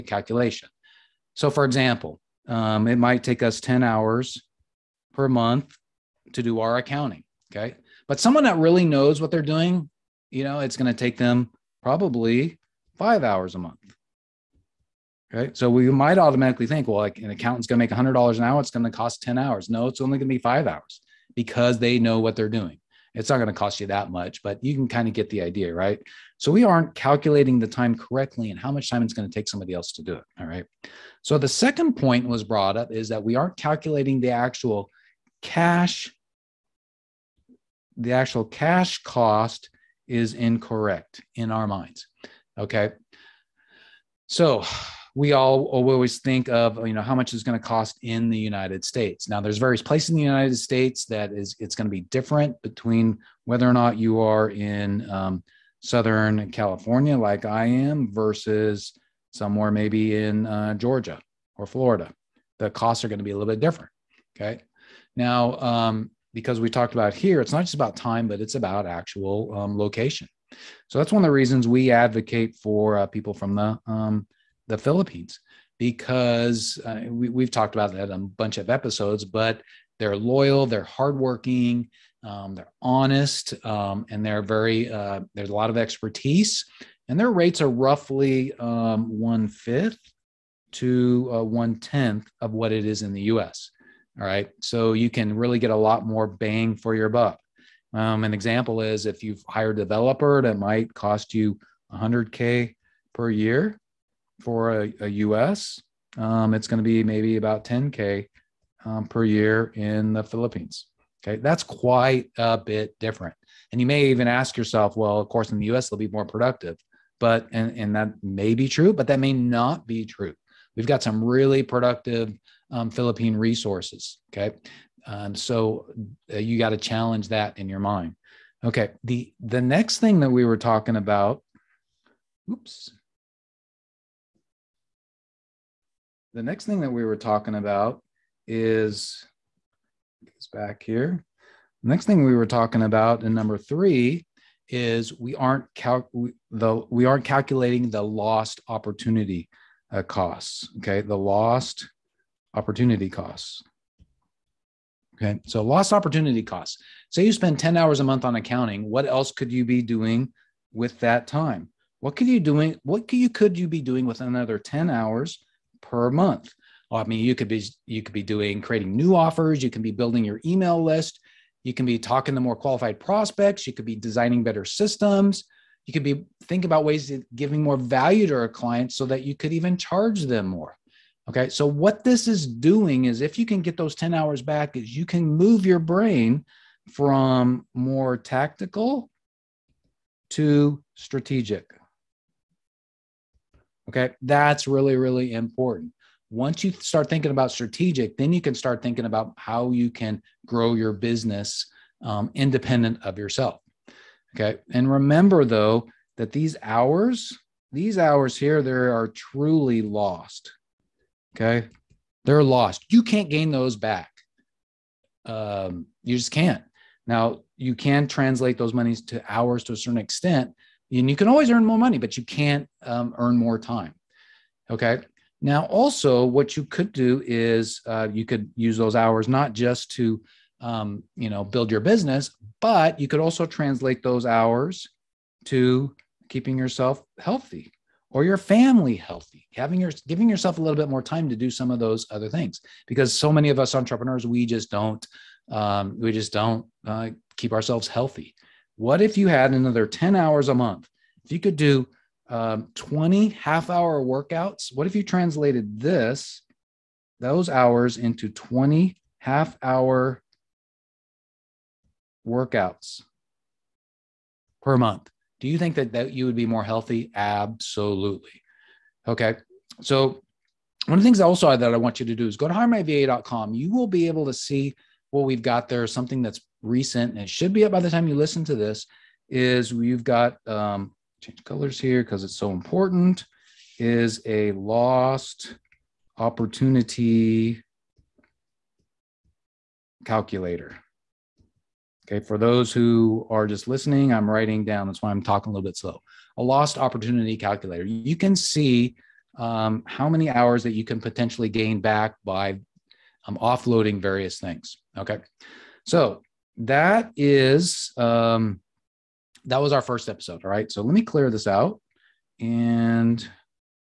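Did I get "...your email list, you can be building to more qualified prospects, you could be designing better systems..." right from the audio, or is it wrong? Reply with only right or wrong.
wrong.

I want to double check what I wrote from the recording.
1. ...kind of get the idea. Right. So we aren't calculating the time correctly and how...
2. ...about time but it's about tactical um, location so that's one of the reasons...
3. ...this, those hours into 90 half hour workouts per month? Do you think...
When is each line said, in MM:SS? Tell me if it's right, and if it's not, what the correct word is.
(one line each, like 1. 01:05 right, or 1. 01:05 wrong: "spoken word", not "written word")
1. 00:24 right
2. 01:07 wrong: "actual", not "tactical"
3. 04:15 wrong: "20", not "90".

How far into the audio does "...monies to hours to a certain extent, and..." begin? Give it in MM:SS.
03:38.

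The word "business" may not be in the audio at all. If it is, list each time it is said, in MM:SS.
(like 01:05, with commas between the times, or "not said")
03:20, 03:51.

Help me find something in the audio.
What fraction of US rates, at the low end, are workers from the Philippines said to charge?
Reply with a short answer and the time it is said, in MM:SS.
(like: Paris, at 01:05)
one tenth, at 01:31.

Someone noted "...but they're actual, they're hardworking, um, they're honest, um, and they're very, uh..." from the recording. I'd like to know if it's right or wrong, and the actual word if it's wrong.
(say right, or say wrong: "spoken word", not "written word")
wrong: "loyal", not "actual".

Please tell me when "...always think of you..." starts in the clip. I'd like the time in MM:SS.
00:45.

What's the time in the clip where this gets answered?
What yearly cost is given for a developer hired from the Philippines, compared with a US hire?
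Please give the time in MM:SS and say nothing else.
01:47.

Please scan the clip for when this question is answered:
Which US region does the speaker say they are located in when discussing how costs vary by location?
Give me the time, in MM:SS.
00:55.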